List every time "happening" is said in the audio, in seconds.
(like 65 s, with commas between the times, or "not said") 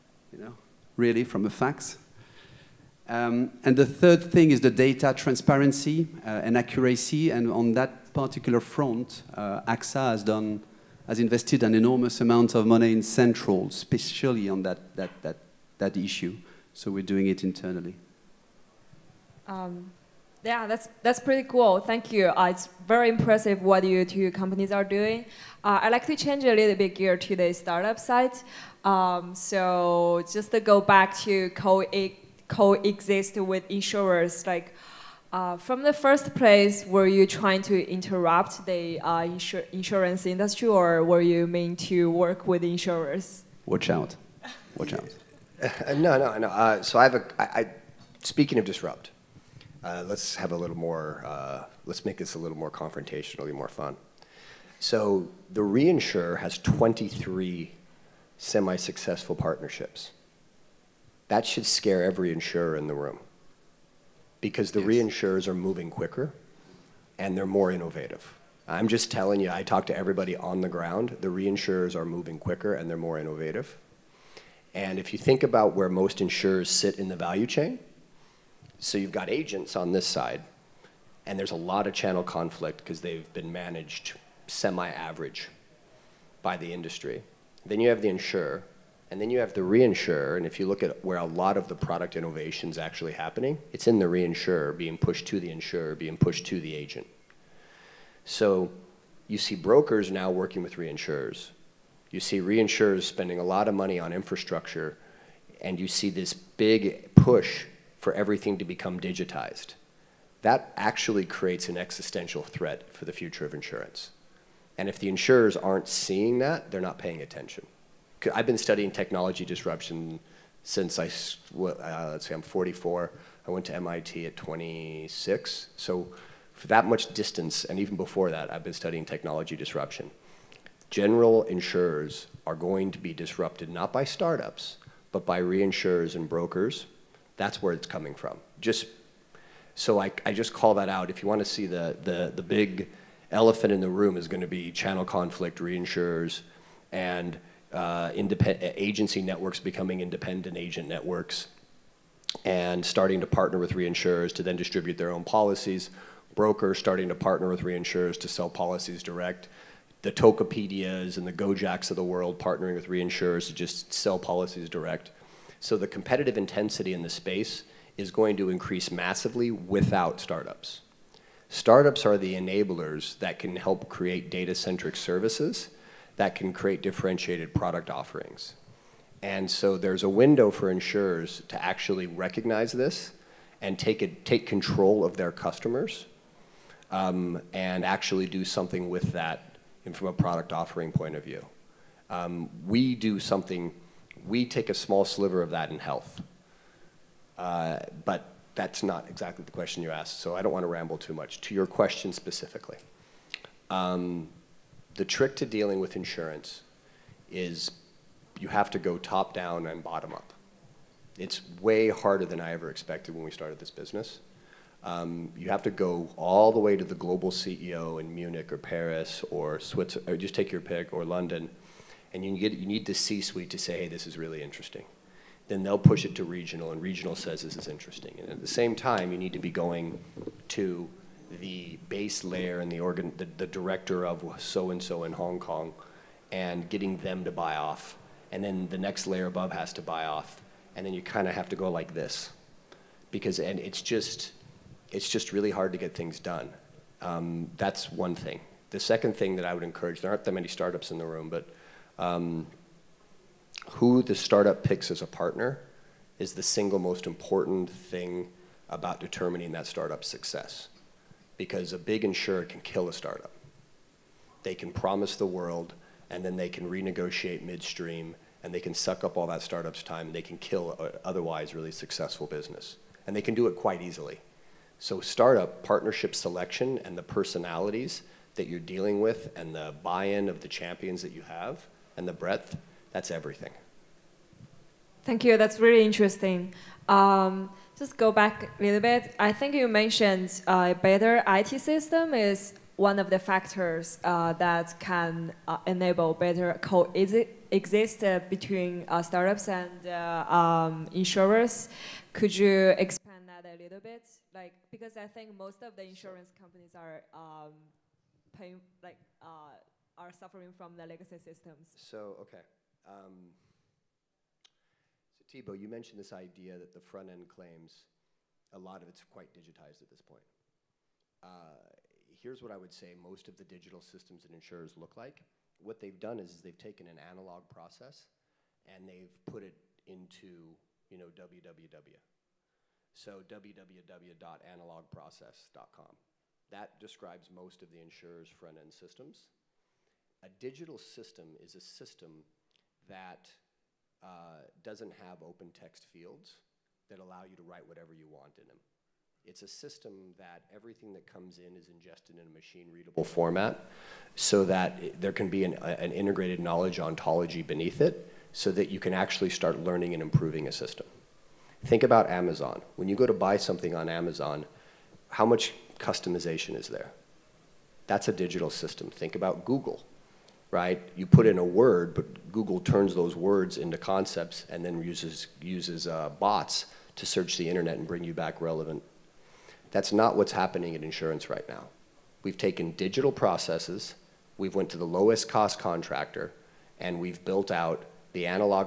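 93 s, 380 s.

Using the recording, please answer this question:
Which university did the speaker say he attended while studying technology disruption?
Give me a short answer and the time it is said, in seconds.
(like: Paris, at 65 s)
MIT, at 123 s.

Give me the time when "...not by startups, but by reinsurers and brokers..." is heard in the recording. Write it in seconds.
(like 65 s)
133 s.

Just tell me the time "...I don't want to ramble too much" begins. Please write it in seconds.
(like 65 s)
200 s.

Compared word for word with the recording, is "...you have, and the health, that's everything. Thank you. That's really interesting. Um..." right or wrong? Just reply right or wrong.
wrong.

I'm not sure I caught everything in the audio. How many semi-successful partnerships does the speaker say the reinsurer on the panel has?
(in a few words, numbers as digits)
23.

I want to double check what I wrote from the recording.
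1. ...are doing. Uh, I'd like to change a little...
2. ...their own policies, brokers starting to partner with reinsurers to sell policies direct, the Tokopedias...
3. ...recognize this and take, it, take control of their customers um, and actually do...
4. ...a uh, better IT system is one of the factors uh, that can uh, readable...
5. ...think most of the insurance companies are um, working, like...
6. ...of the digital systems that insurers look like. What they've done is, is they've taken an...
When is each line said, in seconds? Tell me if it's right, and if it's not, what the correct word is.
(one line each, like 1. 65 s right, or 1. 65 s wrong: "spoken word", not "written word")
1. 24 s right
2. 154 s right
3. 182 s right
4. 290 s wrong: "enable", not "readable"
5. 305 s wrong: "paying", not "working"
6. 323 s right.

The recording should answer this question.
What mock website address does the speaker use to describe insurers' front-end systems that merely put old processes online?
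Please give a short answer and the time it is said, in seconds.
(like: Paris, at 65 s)
www.analogprocess.com, at 333 s.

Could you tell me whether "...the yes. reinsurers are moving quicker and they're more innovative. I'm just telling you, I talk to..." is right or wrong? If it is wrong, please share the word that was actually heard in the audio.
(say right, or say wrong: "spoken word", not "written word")
right.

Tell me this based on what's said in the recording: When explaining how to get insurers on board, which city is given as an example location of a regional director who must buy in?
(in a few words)
Hong Kong.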